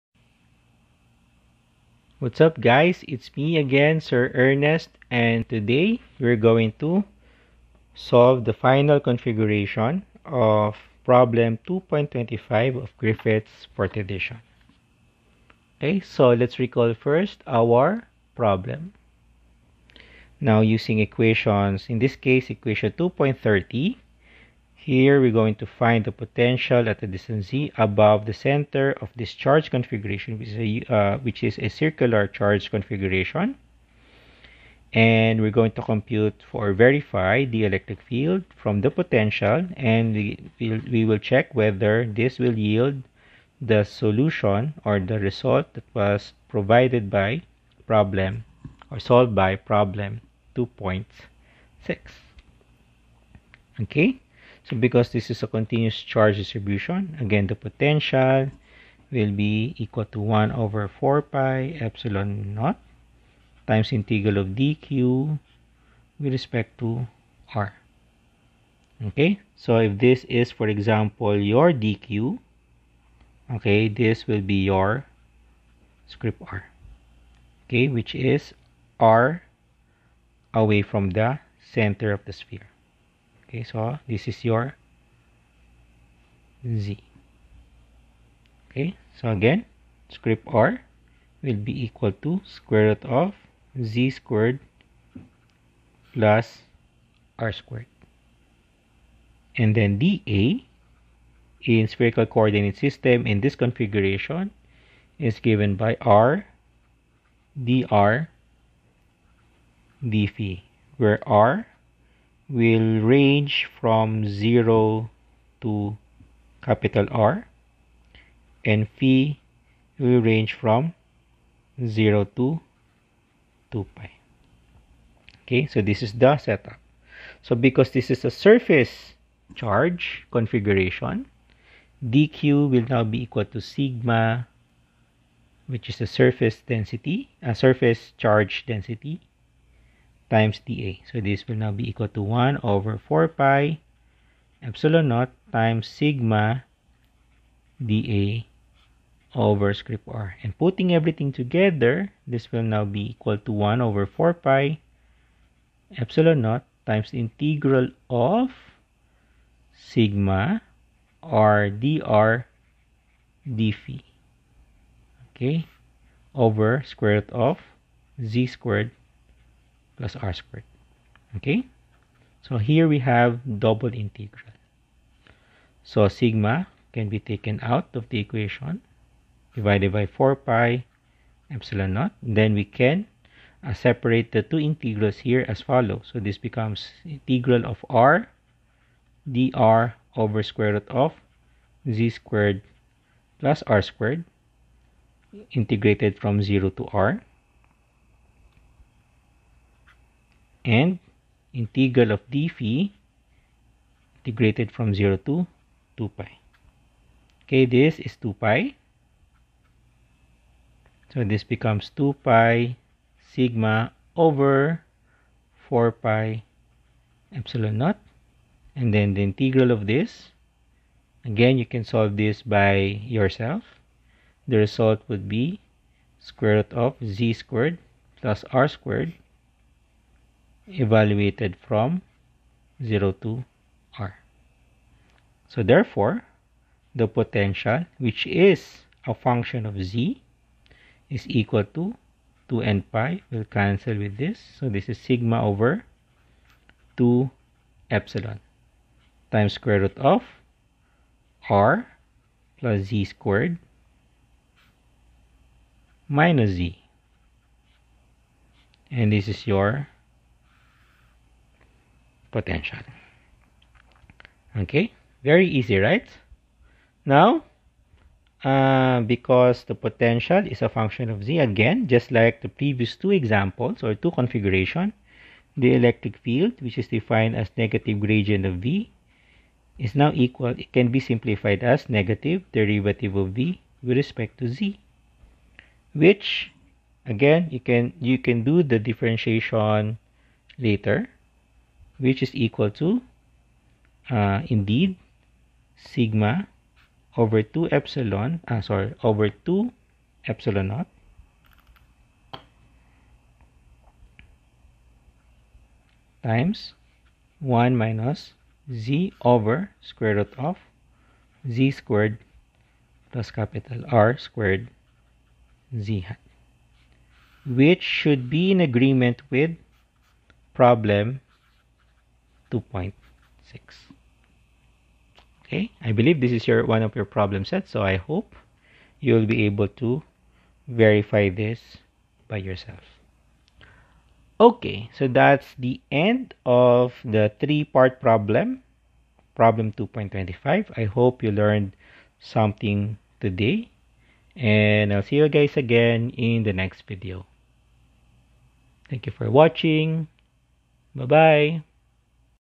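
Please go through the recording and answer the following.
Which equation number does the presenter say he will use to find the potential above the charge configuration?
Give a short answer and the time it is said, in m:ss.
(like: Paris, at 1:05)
2.30, at 0:22.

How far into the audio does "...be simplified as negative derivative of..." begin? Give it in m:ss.
4:40.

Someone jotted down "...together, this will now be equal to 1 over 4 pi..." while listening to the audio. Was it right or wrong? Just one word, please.
right.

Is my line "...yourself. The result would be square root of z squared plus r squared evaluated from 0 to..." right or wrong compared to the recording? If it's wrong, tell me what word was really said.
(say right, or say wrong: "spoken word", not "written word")
right.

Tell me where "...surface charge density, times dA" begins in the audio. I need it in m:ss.
2:17.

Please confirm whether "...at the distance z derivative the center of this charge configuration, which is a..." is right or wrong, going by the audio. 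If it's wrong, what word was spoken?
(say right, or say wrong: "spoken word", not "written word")
wrong: "above", not "derivative".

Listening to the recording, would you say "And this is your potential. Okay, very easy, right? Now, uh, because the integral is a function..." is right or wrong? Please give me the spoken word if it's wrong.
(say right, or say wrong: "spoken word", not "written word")
wrong: "potential", not "integral".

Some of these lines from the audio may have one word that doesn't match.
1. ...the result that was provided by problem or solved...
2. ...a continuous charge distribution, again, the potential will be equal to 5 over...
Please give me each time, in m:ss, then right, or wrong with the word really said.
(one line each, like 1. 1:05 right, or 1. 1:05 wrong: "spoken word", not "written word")
1. 0:44 right
2. 0:55 wrong: "1", not "5".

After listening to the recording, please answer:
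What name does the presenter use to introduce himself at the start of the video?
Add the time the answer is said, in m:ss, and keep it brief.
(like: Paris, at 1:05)
Sir Ernest, at 0:03.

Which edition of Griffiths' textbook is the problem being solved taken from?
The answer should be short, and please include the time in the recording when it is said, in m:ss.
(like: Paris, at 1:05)
Fourth, at 0:13.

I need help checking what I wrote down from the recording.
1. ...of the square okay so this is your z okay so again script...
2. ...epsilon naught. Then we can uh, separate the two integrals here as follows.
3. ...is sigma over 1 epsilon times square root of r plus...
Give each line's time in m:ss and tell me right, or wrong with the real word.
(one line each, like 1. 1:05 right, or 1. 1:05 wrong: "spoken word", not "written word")
1. 1:22 wrong: "sphere", not "square"
2. 3:01 right
3. 4:04 wrong: "2", not "1".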